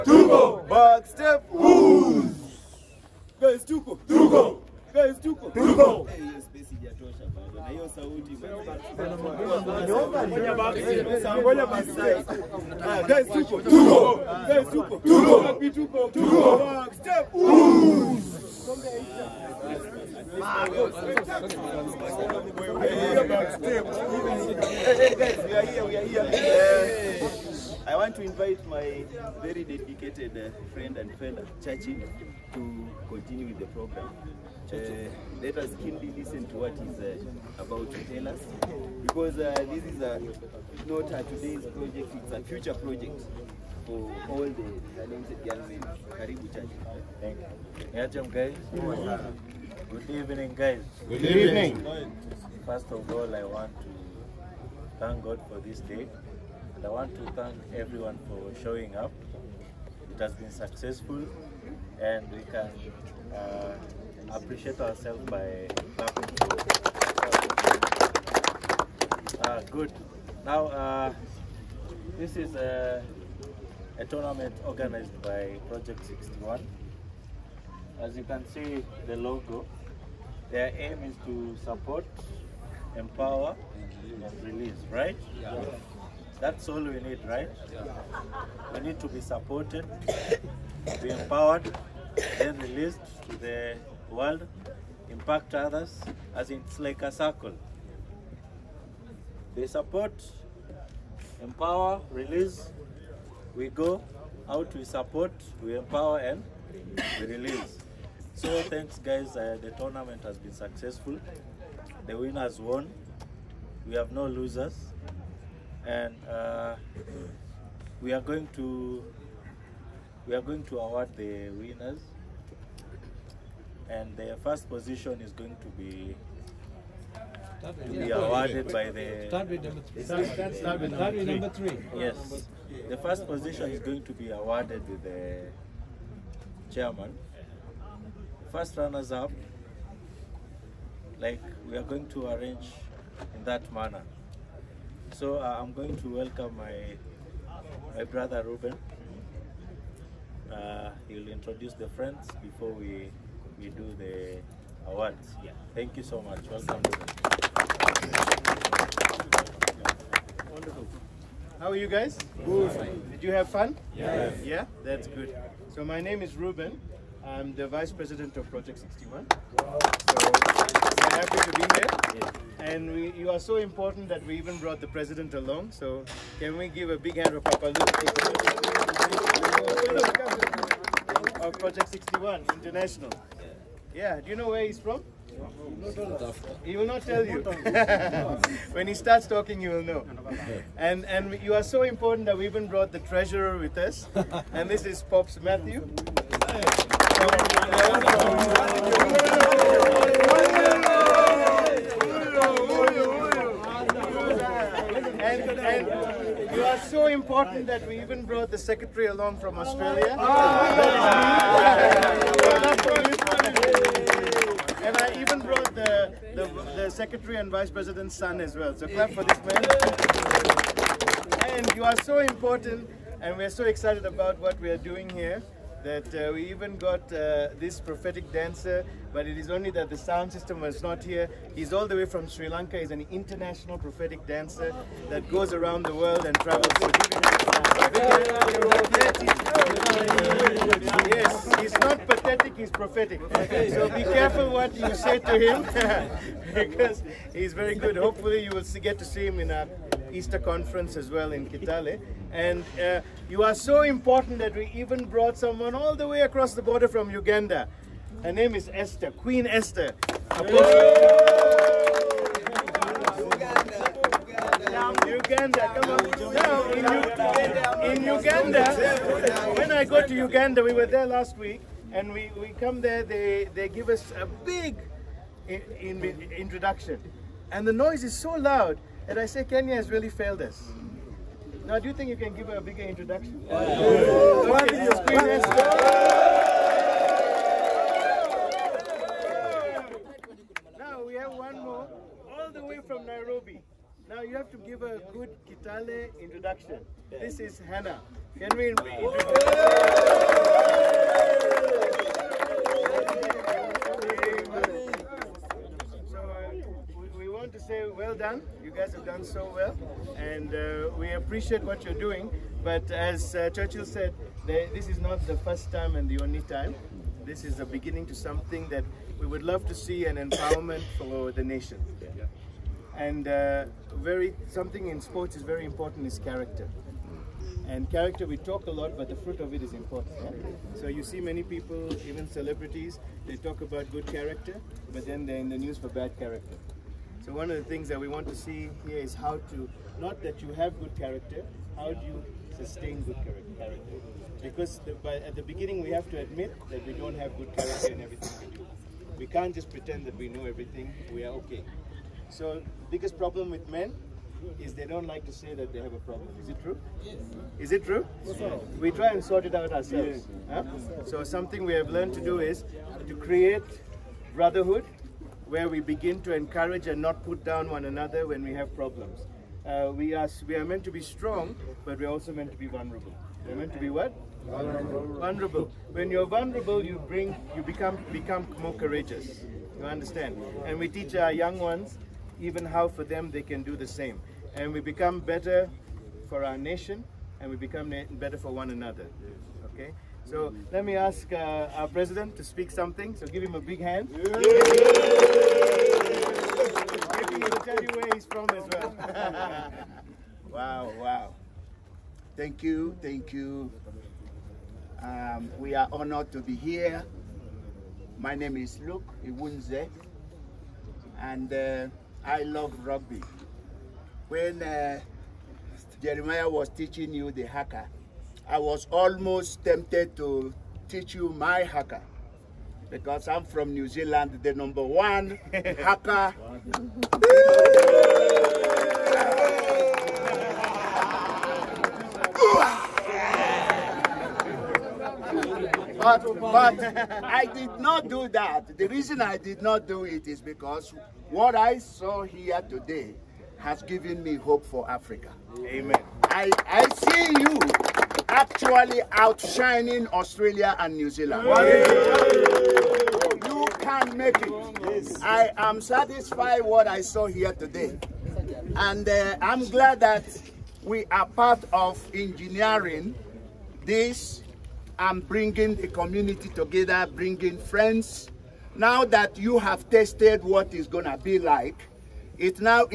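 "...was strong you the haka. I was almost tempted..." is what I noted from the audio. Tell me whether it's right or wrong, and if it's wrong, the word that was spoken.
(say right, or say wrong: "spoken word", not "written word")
wrong: "teaching", not "strong".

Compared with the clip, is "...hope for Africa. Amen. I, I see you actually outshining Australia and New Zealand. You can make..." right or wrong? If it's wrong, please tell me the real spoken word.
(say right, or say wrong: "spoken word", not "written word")
right.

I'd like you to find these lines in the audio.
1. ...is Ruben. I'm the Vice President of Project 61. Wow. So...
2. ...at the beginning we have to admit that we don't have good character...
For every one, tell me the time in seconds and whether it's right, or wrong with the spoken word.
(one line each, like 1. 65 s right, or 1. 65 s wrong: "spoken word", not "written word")
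1. 166 s right
2. 345 s right.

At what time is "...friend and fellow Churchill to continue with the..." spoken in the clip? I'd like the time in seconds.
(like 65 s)
30 s.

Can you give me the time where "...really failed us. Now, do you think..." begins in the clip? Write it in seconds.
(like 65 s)
279 s.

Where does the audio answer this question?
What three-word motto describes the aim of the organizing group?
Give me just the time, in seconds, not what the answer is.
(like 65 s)
81 s.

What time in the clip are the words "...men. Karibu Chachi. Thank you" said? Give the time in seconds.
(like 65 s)
45 s.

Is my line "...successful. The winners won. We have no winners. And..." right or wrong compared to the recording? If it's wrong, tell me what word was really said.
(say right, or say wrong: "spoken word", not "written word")
wrong: "losers", not "winners".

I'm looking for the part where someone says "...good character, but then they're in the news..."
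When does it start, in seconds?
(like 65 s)
333 s.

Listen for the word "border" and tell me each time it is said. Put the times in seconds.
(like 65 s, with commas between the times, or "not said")
256 s.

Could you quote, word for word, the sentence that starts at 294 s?
Now, you have to give a good Kitale introduction.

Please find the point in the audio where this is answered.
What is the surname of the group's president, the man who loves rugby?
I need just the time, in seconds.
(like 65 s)
409 s.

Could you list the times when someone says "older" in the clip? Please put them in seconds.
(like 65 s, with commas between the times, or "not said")
not said.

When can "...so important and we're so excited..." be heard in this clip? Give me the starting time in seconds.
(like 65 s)
222 s.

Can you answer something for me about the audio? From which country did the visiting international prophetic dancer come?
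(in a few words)
Sri Lanka.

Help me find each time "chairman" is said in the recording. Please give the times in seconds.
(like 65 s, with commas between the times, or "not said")
136 s.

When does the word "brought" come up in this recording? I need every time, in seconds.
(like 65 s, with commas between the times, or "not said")
174 s, 192 s, 208 s, 215 s, 255 s.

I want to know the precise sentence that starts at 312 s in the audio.
But as uh, Churchill said, they, this is not the first time and the only time.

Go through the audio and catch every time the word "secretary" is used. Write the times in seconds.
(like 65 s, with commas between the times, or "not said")
208 s, 216 s.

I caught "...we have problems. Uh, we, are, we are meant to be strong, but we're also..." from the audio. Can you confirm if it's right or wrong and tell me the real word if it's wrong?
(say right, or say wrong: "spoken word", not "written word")
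right.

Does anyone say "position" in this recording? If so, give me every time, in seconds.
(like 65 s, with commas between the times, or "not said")
124 s, 133 s.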